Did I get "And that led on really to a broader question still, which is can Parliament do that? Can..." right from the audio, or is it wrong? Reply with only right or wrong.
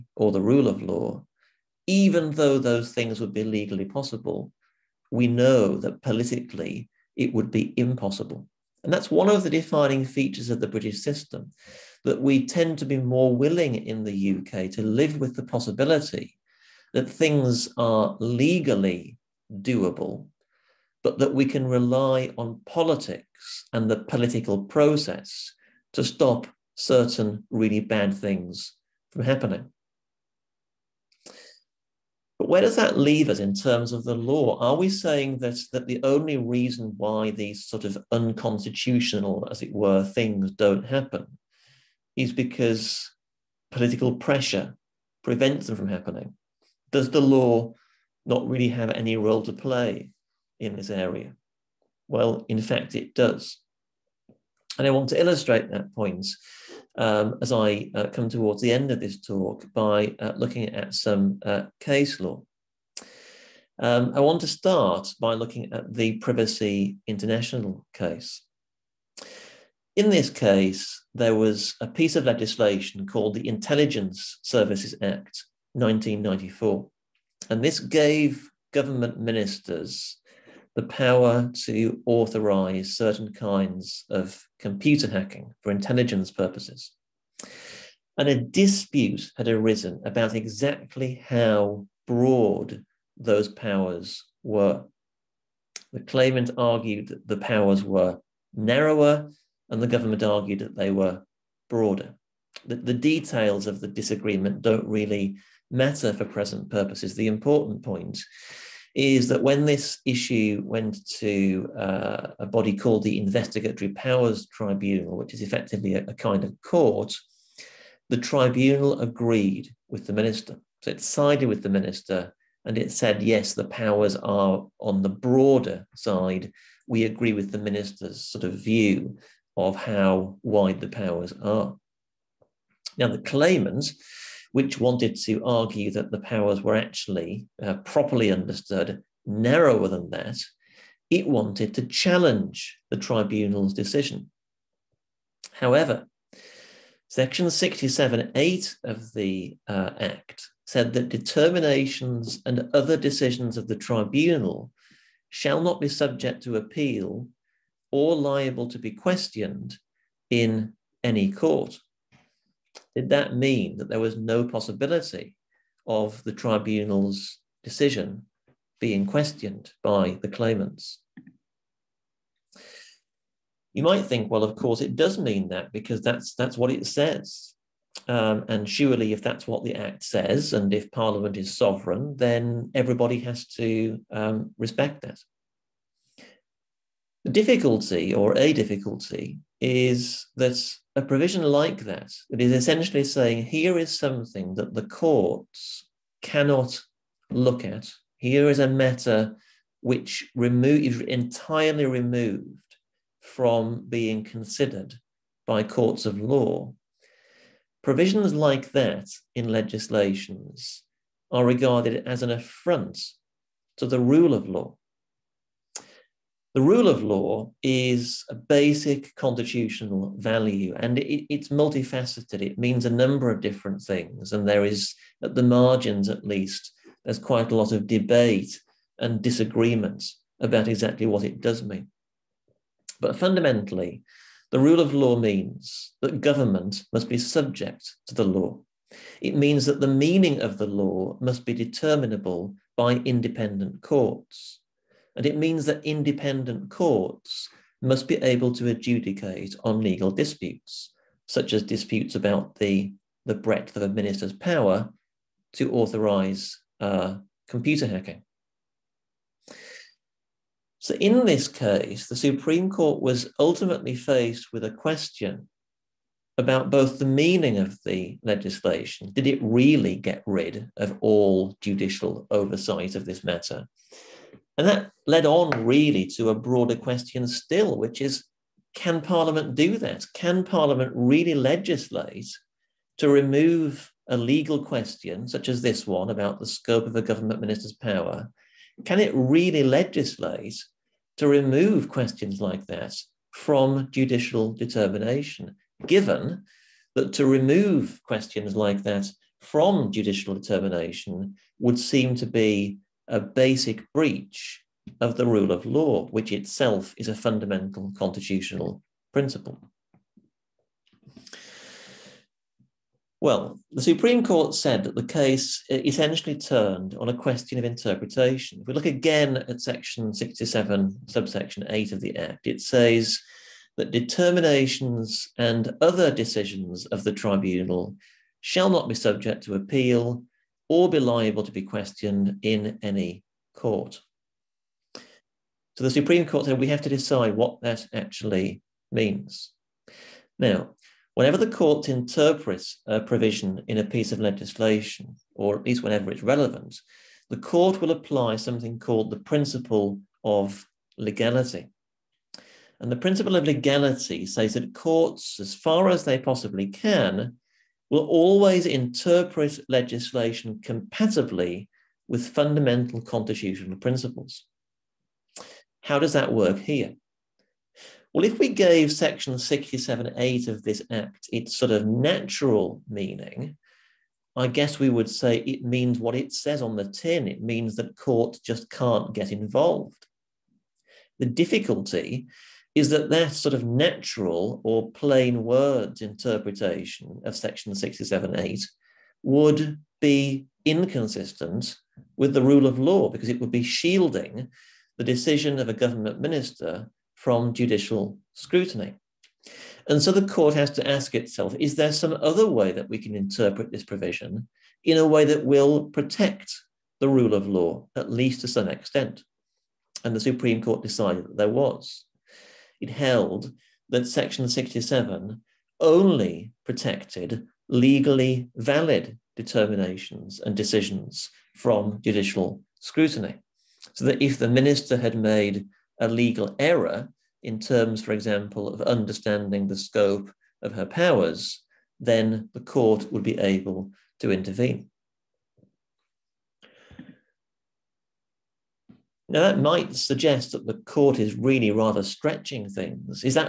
right.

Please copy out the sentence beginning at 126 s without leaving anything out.
We agree with the minister's sort of view of how wide the powers are.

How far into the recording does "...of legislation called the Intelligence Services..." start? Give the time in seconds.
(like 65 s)
72 s.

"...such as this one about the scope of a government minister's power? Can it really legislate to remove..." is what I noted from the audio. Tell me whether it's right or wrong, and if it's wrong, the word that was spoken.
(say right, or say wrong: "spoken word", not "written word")
right.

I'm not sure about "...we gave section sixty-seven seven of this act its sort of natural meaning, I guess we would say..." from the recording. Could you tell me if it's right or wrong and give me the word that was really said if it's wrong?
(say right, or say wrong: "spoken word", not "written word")
wrong: "eight", not "seven".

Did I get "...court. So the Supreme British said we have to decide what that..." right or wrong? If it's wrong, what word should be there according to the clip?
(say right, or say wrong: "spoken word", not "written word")
wrong: "Court", not "British".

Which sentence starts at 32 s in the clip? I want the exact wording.
But where does that leave us in terms of the law?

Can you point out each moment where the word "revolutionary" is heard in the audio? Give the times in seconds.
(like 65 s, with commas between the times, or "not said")
not said.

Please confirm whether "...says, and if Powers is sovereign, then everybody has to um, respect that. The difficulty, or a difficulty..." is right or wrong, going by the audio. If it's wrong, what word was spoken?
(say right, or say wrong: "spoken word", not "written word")
wrong: "Parliament", not "Powers".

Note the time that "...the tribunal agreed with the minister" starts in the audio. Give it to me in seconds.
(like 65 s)
118 s.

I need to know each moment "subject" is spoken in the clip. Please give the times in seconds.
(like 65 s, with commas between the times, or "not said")
155 s, 237 s, 328 s.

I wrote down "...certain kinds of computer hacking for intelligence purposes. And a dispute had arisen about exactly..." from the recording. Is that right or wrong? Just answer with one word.
right.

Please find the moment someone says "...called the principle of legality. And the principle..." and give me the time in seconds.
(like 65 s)
348 s.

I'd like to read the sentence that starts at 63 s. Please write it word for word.
Um, I want to start by looking at the Privacy International case.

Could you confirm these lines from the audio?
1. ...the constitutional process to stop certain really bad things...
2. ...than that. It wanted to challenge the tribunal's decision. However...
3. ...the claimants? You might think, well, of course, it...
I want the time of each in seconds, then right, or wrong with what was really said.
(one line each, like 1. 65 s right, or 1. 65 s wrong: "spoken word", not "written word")
1. 23 s wrong: "political", not "constitutional"
2. 139 s right
3. 170 s right.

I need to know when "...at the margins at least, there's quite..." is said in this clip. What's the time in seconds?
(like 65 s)
225 s.